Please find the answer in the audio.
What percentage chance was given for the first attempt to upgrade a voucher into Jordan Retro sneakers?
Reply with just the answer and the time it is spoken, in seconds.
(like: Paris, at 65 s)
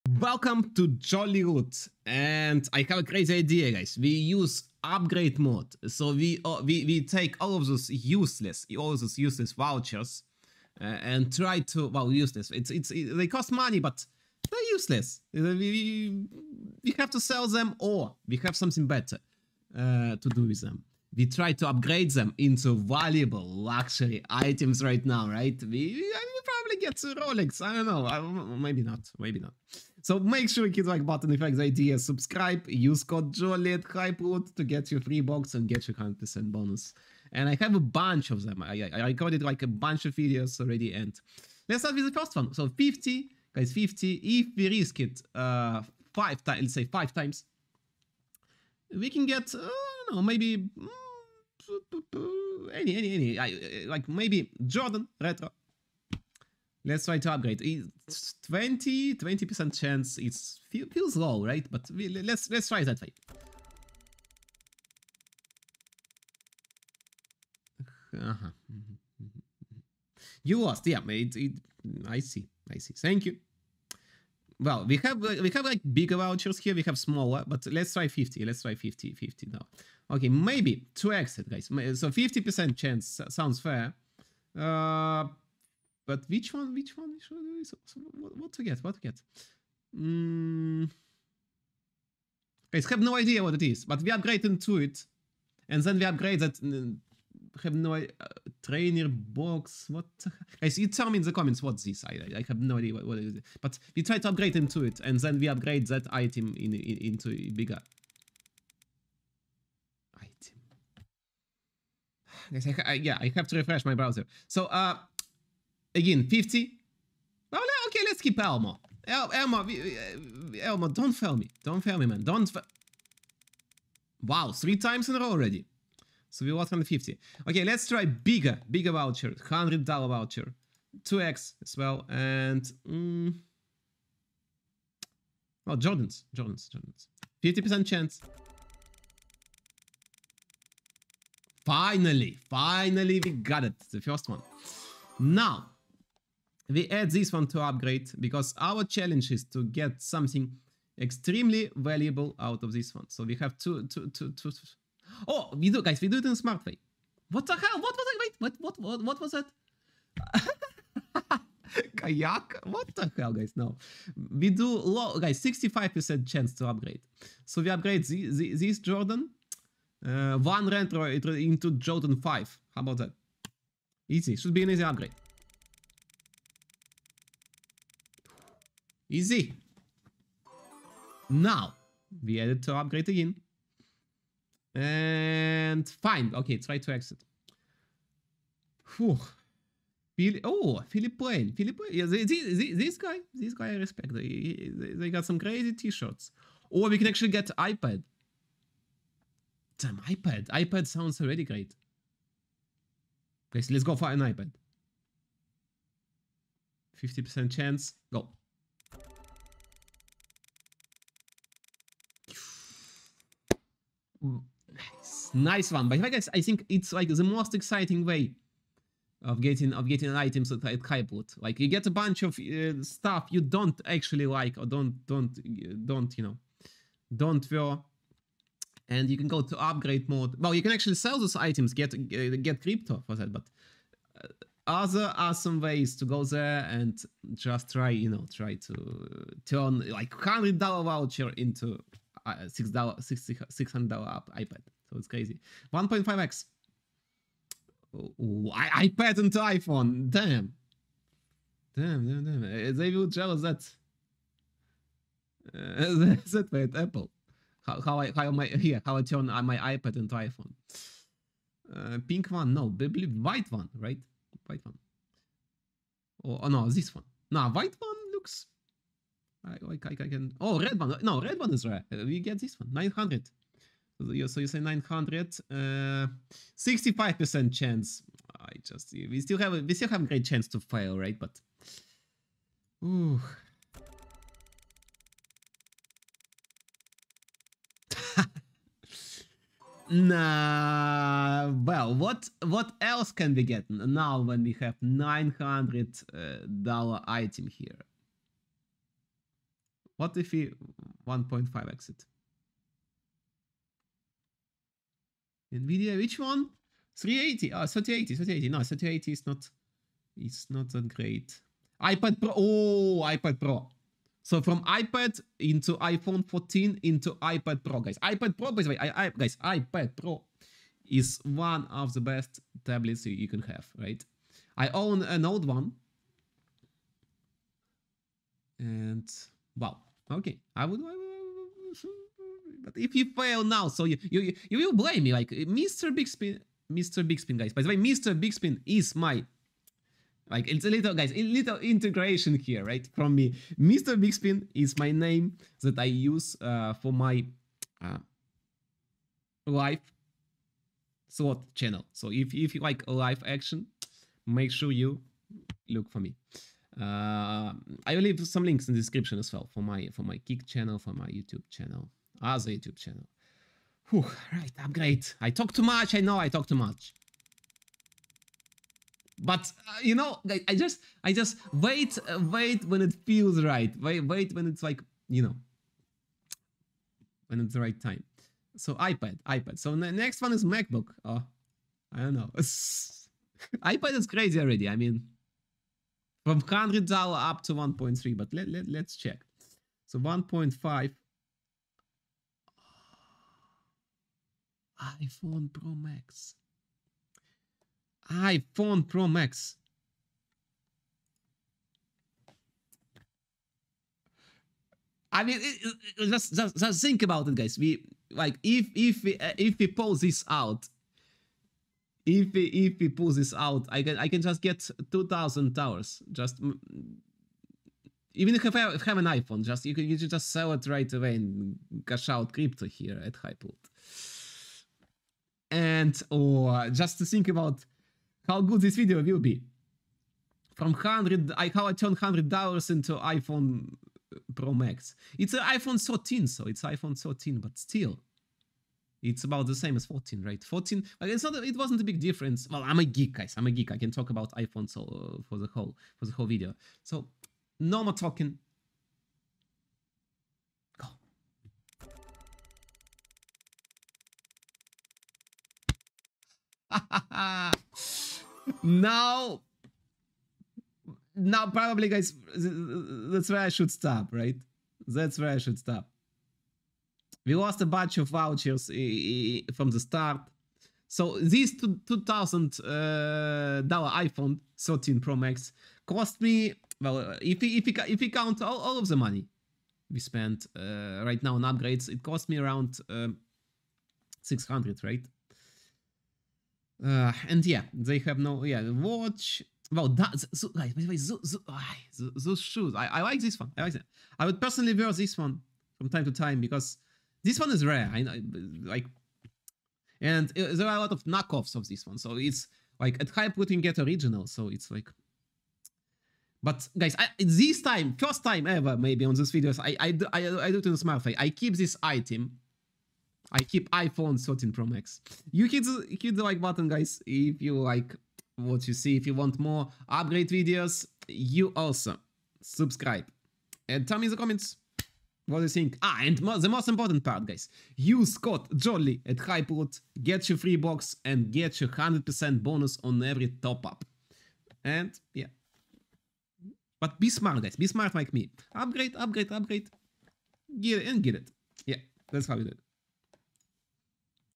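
20%, at 58 s.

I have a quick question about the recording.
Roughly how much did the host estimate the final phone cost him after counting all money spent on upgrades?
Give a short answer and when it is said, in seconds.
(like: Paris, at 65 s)
600, at 484 s.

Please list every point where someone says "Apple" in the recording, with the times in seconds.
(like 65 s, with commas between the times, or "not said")
256 s.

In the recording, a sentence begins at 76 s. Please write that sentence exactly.
We have smaller, but let's try 50.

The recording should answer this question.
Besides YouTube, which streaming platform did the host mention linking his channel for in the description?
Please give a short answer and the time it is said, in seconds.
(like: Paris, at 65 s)
Kick, at 360 s.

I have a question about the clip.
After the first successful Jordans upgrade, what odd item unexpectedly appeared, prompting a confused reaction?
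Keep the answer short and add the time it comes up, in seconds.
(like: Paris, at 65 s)
Kayak, at 161 s.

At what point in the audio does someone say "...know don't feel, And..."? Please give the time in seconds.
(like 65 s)
226 s.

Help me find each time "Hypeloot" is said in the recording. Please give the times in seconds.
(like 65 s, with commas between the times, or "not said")
33 s, 220 s, 423 s, 529 s.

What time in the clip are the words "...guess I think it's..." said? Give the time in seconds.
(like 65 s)
216 s.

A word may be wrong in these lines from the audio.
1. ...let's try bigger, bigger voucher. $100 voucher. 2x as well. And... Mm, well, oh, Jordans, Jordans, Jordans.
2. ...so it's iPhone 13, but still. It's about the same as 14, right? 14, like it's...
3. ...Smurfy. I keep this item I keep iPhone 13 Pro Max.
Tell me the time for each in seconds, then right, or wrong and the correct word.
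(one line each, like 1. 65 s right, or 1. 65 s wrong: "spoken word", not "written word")
1. 127 s right
2. 436 s right
3. 510 s right.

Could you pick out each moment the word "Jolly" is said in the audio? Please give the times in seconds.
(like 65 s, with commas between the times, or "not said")
0 s, 33 s, 528 s.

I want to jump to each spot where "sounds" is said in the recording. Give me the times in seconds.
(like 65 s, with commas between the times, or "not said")
83 s, 200 s.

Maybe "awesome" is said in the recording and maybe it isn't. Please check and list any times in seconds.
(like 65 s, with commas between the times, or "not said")
235 s.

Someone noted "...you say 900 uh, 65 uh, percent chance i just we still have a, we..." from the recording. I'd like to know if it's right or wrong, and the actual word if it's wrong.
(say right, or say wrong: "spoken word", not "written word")
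right.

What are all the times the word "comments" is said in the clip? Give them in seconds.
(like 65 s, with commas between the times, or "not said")
101 s, 425 s, 524 s.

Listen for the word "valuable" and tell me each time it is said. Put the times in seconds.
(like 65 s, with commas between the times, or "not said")
22 s, 151 s.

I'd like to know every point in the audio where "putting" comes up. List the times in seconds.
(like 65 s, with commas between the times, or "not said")
503 s.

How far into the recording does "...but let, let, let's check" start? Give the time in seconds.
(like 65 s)
388 s.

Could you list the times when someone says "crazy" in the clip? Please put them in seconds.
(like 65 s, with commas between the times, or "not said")
3 s, 195 s, 245 s, 384 s.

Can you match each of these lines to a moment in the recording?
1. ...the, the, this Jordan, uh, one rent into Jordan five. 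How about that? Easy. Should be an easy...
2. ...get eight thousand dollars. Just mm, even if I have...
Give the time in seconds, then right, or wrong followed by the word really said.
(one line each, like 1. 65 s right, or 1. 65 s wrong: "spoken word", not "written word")
1. 168 s right
2. 414 s wrong: "two", not "eight".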